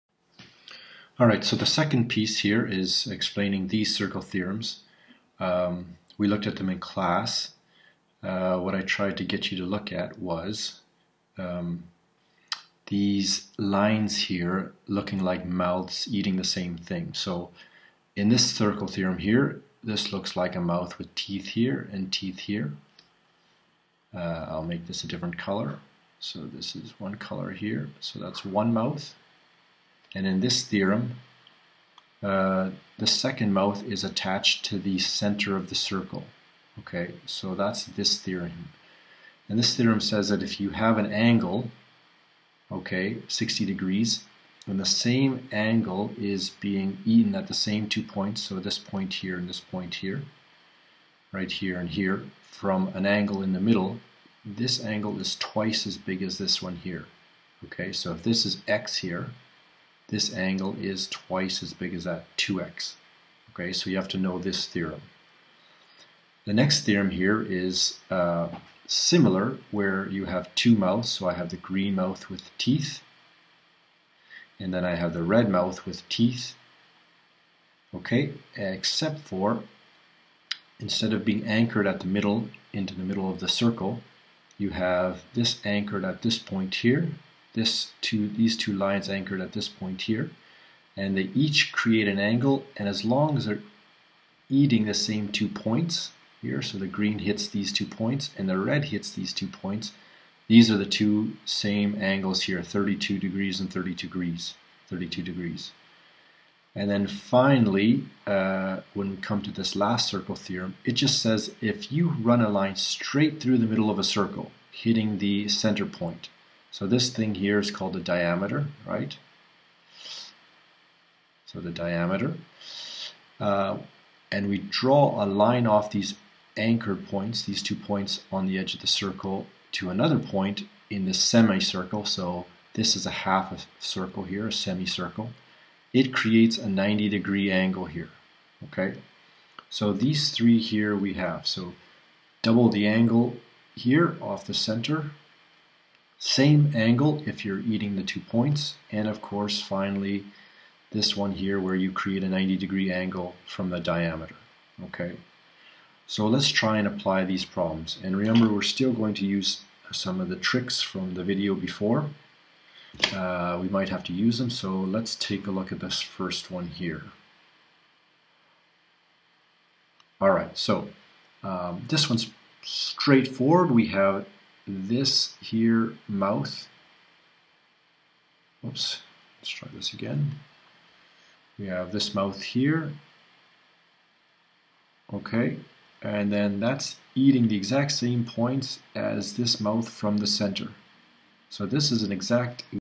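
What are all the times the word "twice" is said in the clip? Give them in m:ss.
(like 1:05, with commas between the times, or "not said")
0:55, 1:01.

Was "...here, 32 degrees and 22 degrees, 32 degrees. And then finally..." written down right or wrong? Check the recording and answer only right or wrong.
wrong.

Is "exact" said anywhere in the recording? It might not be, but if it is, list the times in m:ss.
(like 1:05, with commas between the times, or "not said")
3:07, 3:12.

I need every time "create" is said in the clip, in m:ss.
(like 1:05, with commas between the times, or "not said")
1:31, 2:16, 2:31.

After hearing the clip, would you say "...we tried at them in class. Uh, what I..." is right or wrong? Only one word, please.
wrong.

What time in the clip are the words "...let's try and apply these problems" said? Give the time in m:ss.
2:36.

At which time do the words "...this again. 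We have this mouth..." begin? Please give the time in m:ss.
2:59.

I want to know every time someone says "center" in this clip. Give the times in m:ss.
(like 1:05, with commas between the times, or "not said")
0:34, 1:55, 2:24, 3:10.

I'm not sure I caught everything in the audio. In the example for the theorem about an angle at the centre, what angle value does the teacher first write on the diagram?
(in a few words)
60 degrees.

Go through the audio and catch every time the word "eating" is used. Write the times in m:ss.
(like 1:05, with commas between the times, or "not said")
0:16, 1:34, 2:27, 3:07.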